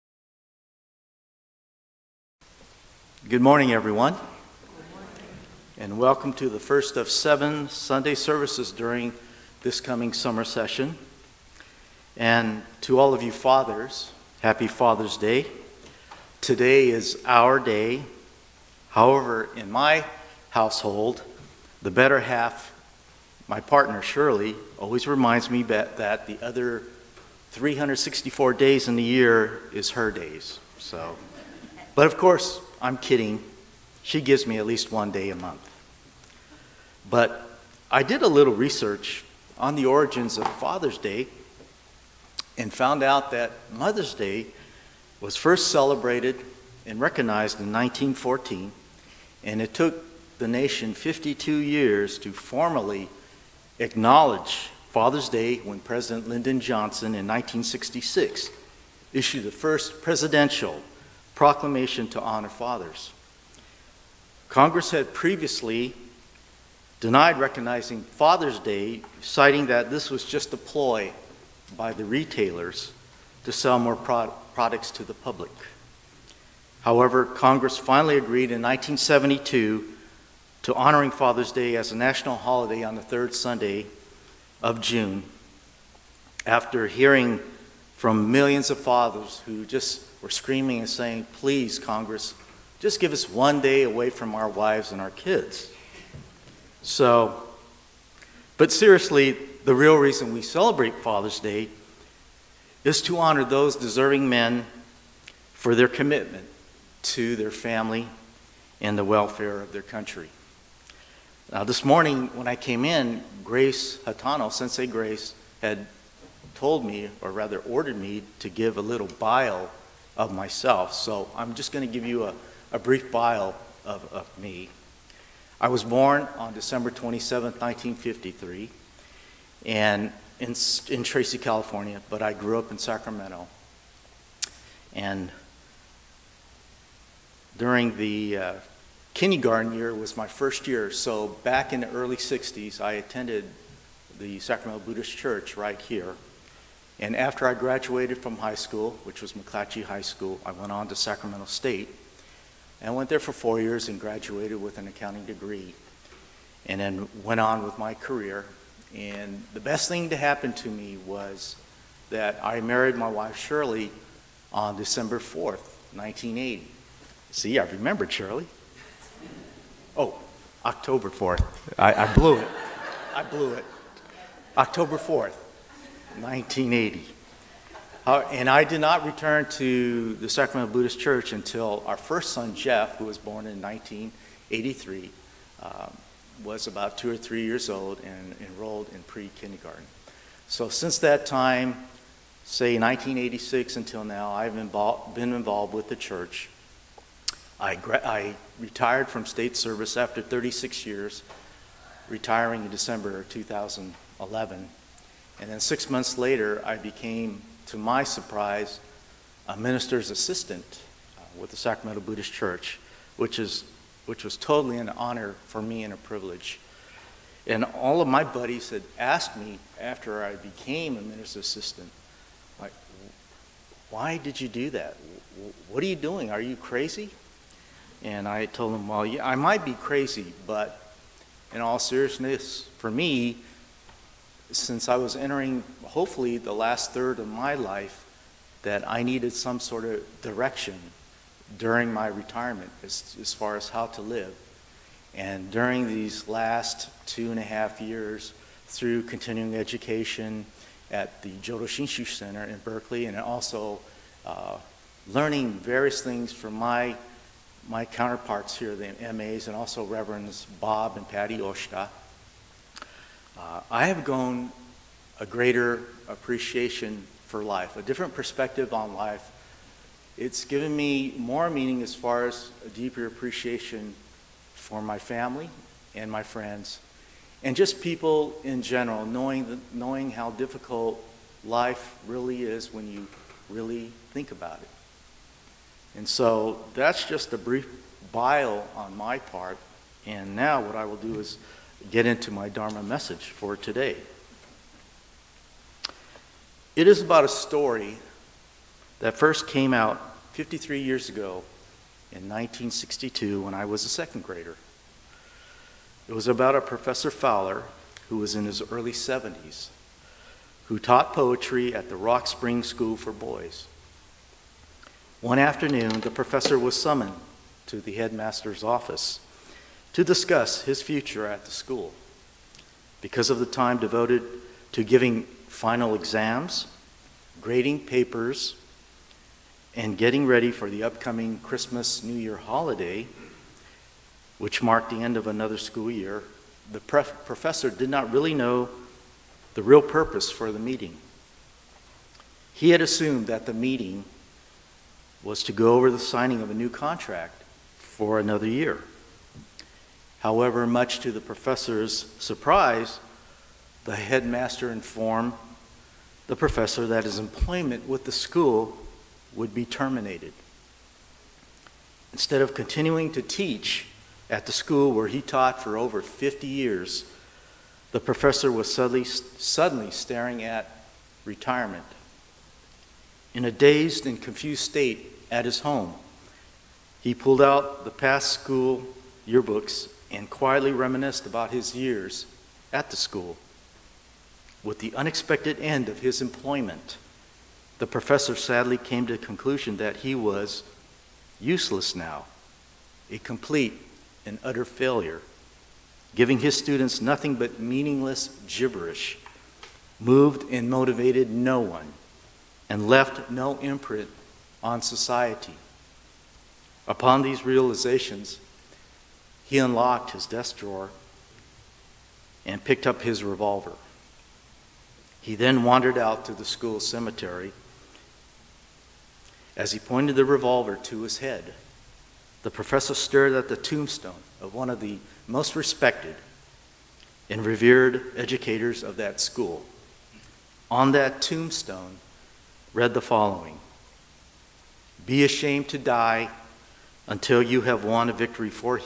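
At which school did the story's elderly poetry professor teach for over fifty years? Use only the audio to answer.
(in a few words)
Rock Spring School for Boys.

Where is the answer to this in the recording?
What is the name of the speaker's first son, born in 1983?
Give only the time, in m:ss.
3:02.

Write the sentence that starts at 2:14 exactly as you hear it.
And during the uh, kindergarten year was my first year.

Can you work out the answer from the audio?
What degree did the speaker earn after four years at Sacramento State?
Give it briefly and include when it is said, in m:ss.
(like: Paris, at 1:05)
accounting degree, at 2:34.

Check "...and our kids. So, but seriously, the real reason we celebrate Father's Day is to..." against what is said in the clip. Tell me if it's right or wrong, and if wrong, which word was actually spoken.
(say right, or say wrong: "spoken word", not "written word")
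right.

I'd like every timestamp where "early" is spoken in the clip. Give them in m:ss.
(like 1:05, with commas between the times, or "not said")
2:21, 5:08.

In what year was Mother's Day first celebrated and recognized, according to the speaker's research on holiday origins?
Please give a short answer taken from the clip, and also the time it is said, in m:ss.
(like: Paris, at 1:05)
1914, at 0:47.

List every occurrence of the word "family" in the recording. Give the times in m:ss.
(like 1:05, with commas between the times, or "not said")
1:47, 4:34.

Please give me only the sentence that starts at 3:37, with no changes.
And all of my buddies had asked me after I became a minister's assistant, like, why did you do that?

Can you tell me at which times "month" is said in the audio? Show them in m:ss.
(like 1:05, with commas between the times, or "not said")
0:35, 3:25.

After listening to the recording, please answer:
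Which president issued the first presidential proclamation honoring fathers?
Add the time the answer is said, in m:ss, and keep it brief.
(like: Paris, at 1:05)
Lyndon Johnson, at 0:56.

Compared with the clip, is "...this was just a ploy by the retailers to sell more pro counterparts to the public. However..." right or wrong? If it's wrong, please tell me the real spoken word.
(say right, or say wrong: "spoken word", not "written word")
wrong: "products", not "counterparts".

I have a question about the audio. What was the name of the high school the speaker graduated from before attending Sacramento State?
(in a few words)
McClatchy High School.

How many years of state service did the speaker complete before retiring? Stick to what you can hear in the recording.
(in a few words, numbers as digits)
36.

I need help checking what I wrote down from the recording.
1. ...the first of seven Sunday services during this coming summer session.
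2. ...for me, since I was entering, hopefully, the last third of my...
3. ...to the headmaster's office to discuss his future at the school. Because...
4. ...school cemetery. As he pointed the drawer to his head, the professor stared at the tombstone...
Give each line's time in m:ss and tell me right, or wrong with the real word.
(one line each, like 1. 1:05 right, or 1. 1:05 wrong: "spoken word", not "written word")
1. 0:06 right
2. 3:52 right
3. 5:17 right
4. 6:56 wrong: "revolver", not "drawer".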